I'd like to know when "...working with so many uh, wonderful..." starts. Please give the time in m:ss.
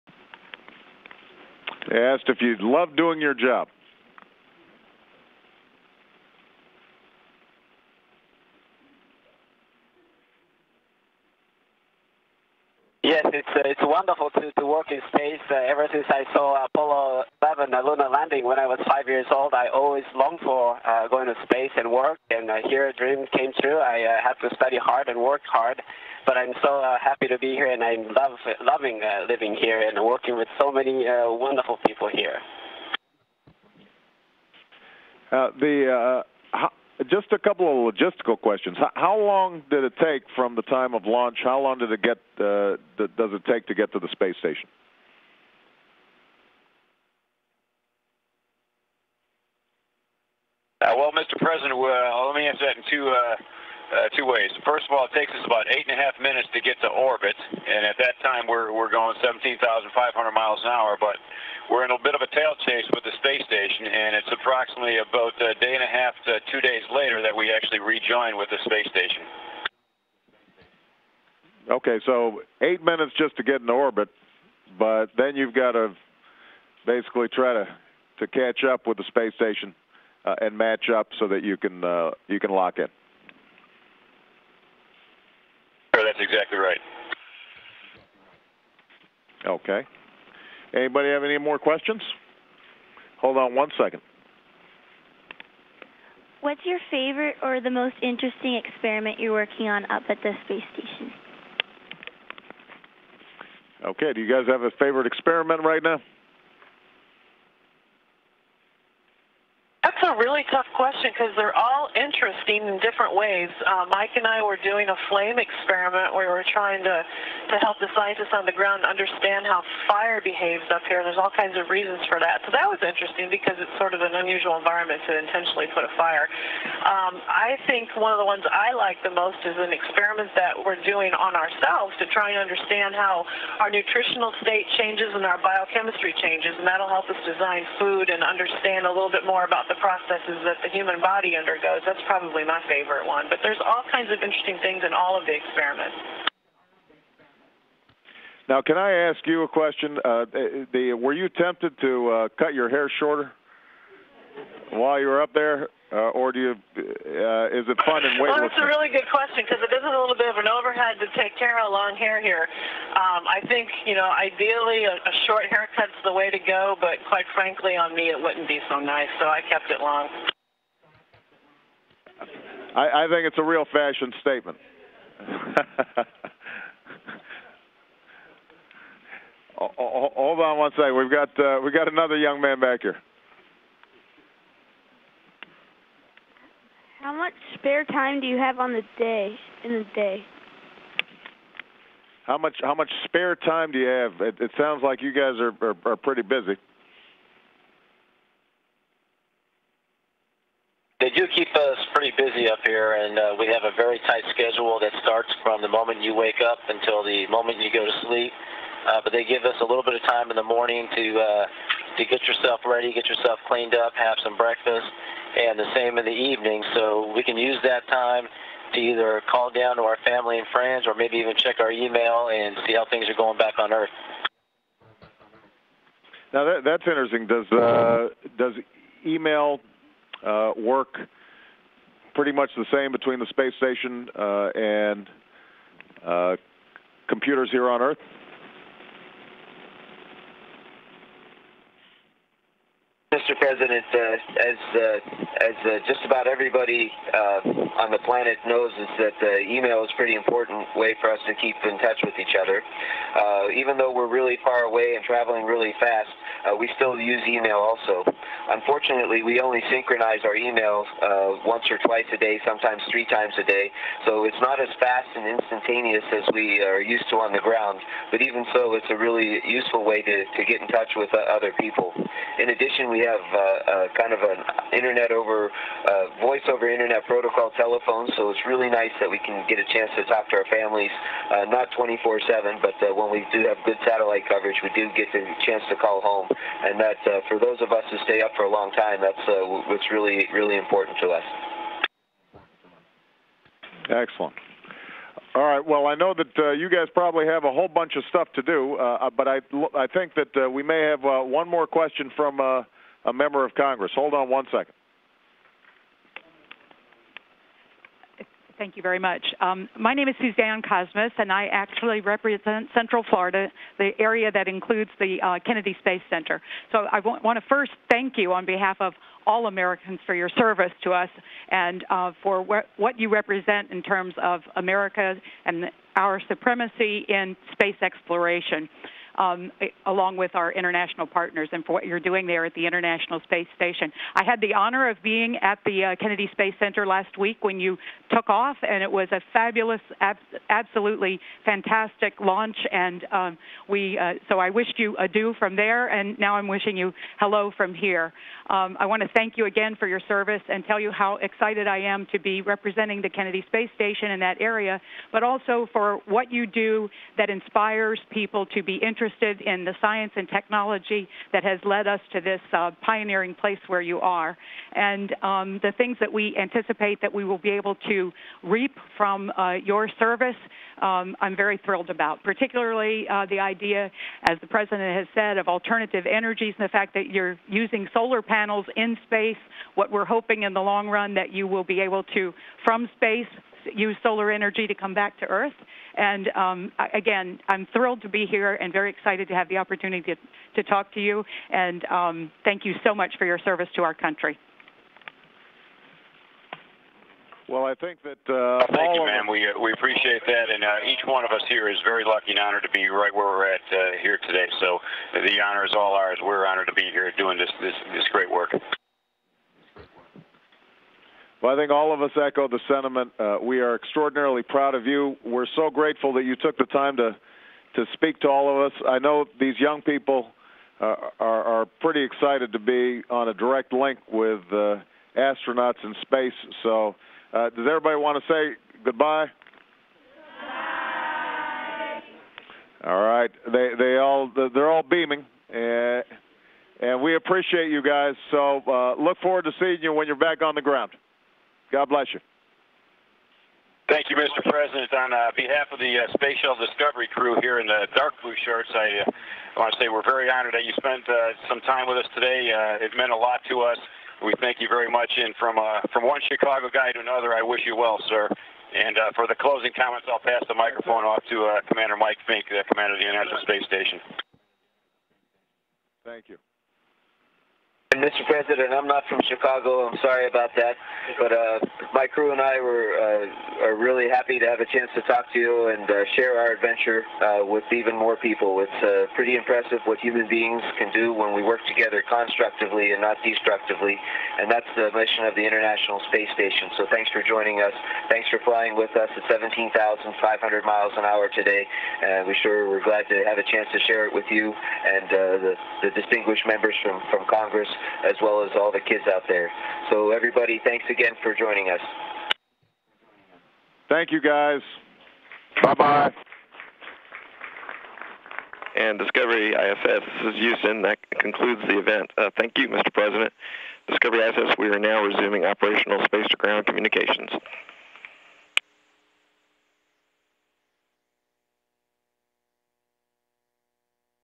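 0:30.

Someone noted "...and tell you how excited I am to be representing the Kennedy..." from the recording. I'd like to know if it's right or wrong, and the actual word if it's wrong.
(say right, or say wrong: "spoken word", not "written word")
right.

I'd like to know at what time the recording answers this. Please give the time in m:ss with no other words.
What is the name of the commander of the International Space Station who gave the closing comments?
7:41.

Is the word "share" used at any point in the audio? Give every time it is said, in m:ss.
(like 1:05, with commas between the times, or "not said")
7:56, 8:13.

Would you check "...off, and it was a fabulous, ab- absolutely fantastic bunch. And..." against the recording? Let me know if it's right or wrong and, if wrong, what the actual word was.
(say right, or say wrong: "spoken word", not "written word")
wrong: "launch", not "bunch".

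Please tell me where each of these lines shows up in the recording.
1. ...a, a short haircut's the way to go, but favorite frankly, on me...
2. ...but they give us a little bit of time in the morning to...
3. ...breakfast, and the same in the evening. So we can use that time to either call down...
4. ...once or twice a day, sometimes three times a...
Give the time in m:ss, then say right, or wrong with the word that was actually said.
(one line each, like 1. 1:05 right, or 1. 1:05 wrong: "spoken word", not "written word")
1. 2:44 wrong: "quite", not "favorite"
2. 3:29 right
3. 3:34 right
4. 4:21 right.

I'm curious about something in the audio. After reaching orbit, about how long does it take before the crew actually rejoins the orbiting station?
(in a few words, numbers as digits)
1.5 to 2 days.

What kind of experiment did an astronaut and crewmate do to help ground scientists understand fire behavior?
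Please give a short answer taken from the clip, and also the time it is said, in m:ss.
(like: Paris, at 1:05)
Flame experiment, at 1:55.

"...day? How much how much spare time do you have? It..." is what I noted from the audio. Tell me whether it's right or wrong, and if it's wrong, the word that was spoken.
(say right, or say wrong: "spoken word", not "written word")
right.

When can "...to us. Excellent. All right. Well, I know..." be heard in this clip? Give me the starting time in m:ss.
4:51.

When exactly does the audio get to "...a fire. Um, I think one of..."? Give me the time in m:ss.
2:05.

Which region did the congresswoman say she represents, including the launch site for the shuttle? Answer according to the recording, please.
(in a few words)
Central Florida.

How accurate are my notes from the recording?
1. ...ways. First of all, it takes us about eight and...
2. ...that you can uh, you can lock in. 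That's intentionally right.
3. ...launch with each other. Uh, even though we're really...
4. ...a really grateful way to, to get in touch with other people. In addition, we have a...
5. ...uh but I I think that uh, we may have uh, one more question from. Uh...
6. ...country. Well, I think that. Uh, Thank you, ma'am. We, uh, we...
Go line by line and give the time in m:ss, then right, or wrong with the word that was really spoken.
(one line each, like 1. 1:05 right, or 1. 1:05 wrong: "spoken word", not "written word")
1. 0:54 right
2. 1:21 wrong: "exactly", not "intentionally"
3. 4:11 wrong: "touch", not "launch"
4. 4:28 wrong: "useful", not "grateful"
5. 4:59 right
6. 6:33 right.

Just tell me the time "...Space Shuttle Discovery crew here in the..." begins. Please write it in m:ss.
7:26.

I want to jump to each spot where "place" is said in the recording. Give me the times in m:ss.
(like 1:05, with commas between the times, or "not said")
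6:03.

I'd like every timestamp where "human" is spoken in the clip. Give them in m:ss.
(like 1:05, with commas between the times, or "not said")
2:20, 7:59.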